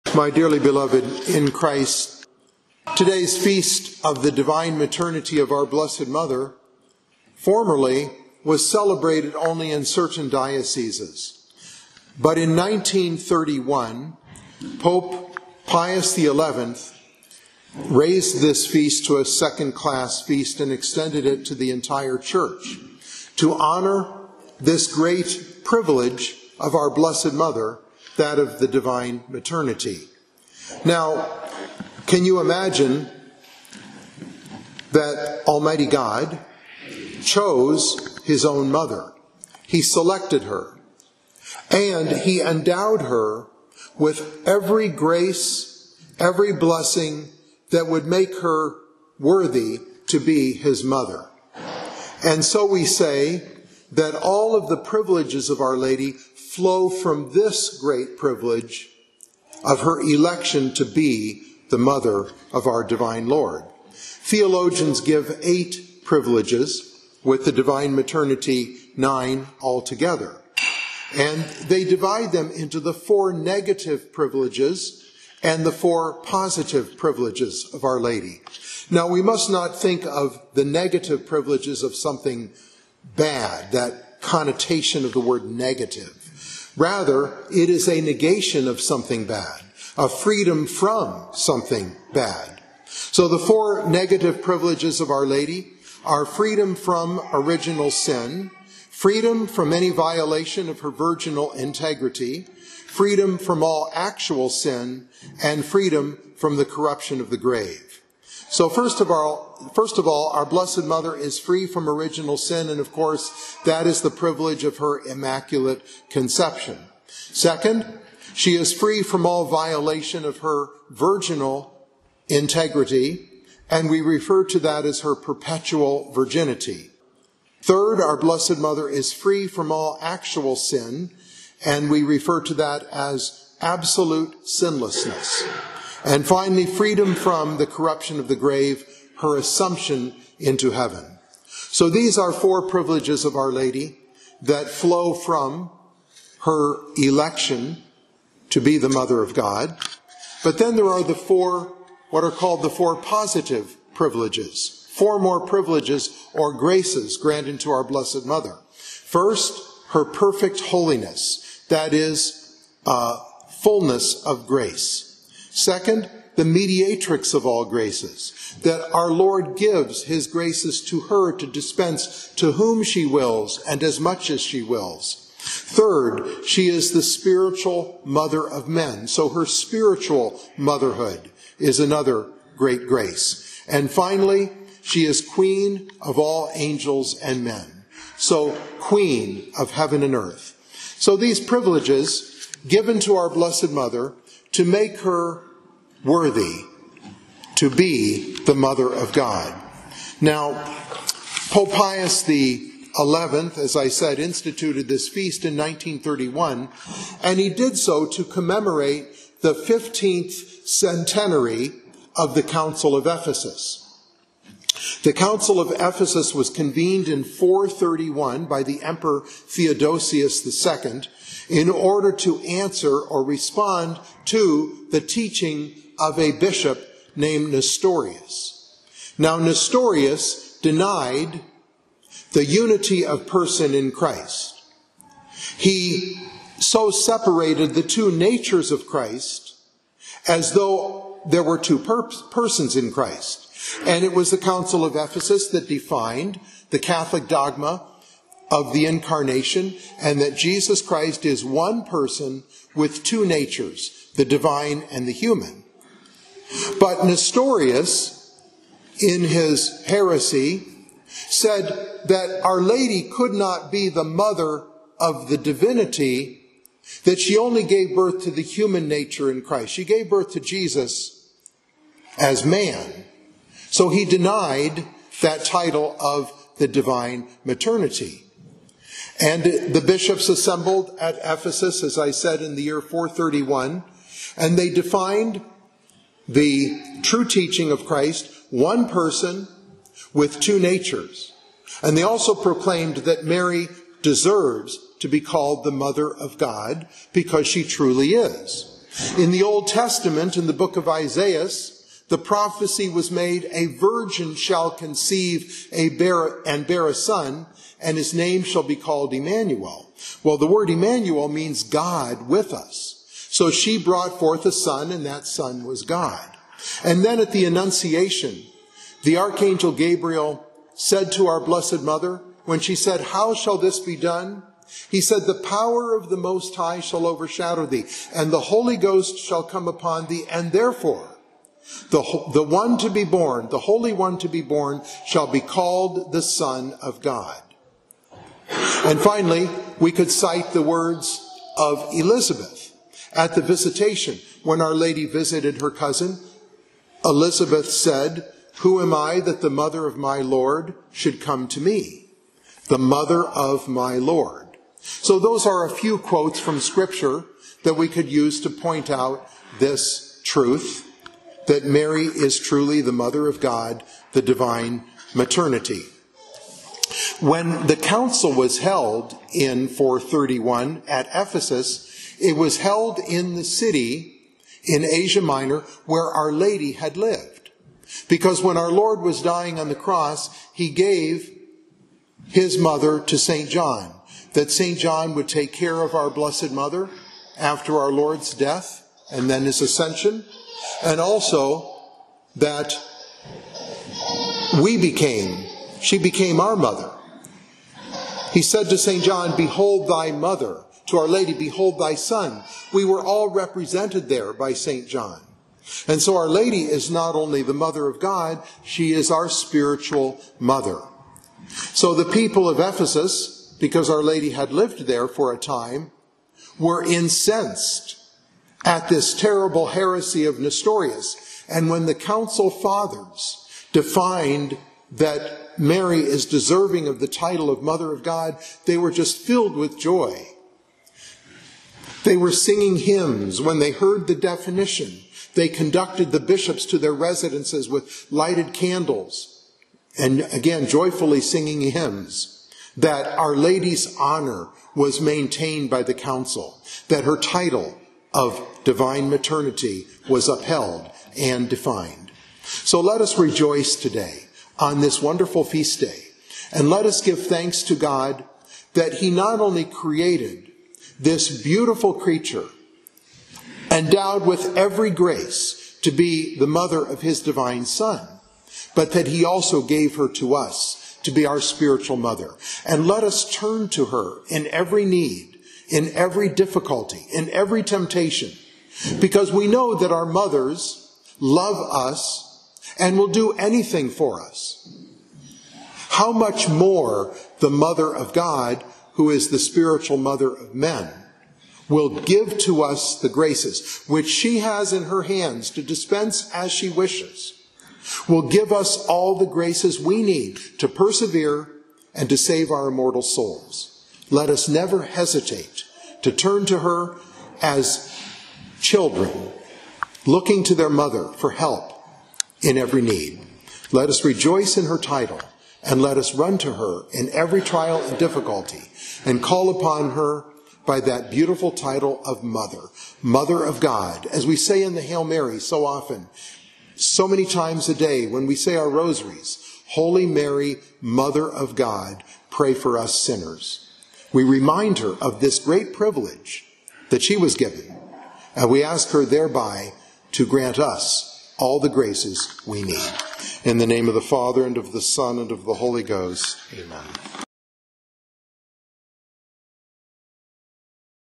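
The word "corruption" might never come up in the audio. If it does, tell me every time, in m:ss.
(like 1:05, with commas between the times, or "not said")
1:46, 2:17.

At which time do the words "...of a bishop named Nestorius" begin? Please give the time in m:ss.
3:45.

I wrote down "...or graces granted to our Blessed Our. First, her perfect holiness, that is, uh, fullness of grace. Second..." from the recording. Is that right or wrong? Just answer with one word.
wrong.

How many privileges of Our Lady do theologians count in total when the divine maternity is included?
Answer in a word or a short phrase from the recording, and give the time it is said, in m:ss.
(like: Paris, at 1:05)
9, at 1:08.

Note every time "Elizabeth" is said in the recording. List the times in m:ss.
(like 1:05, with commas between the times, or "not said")
5:41, 5:47.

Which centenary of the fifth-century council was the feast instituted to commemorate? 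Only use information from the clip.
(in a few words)
15th.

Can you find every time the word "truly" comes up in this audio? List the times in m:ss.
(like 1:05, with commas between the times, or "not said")
4:57, 6:02.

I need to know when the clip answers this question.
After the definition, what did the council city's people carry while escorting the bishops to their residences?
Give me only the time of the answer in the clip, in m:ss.
7:18.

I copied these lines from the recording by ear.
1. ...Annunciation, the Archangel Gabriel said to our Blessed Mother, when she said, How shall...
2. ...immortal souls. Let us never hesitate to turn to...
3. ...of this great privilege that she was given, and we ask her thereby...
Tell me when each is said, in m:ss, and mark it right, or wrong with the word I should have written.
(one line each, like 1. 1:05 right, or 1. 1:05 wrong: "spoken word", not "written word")
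1. 5:17 right
2. 8:22 right
3. 8:55 right.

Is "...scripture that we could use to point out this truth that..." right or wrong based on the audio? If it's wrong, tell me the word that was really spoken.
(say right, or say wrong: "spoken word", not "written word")
right.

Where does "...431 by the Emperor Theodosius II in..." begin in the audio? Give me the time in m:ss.
3:37.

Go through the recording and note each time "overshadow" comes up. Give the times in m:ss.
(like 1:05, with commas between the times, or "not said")
5:27.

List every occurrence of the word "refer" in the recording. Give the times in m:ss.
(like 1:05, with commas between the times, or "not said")
2:04, 2:12.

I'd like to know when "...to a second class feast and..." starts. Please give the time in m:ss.
0:19.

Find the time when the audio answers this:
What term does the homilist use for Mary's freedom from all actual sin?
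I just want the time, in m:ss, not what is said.
2:13.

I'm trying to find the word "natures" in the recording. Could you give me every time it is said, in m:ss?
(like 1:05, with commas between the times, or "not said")
3:58, 4:13, 4:28, 4:50.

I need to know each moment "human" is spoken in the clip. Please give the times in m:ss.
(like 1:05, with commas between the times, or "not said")
4:15, 4:28.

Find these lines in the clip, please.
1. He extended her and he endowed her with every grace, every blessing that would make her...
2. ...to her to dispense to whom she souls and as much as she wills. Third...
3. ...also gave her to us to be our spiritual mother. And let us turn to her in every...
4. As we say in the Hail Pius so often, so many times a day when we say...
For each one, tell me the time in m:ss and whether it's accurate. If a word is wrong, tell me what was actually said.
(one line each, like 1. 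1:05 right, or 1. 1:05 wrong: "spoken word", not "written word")
1. 0:39 wrong: "selected", not "extended"
2. 2:50 wrong: "wills", not "souls"
3. 7:49 right
4. 8:44 wrong: "Mary", not "Pius".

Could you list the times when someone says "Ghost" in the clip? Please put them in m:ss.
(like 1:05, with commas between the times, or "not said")
5:28, 9:05.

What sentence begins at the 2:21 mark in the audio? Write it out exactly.
So these are four privileges of Our Lady that flow from her election to be the Mother of God.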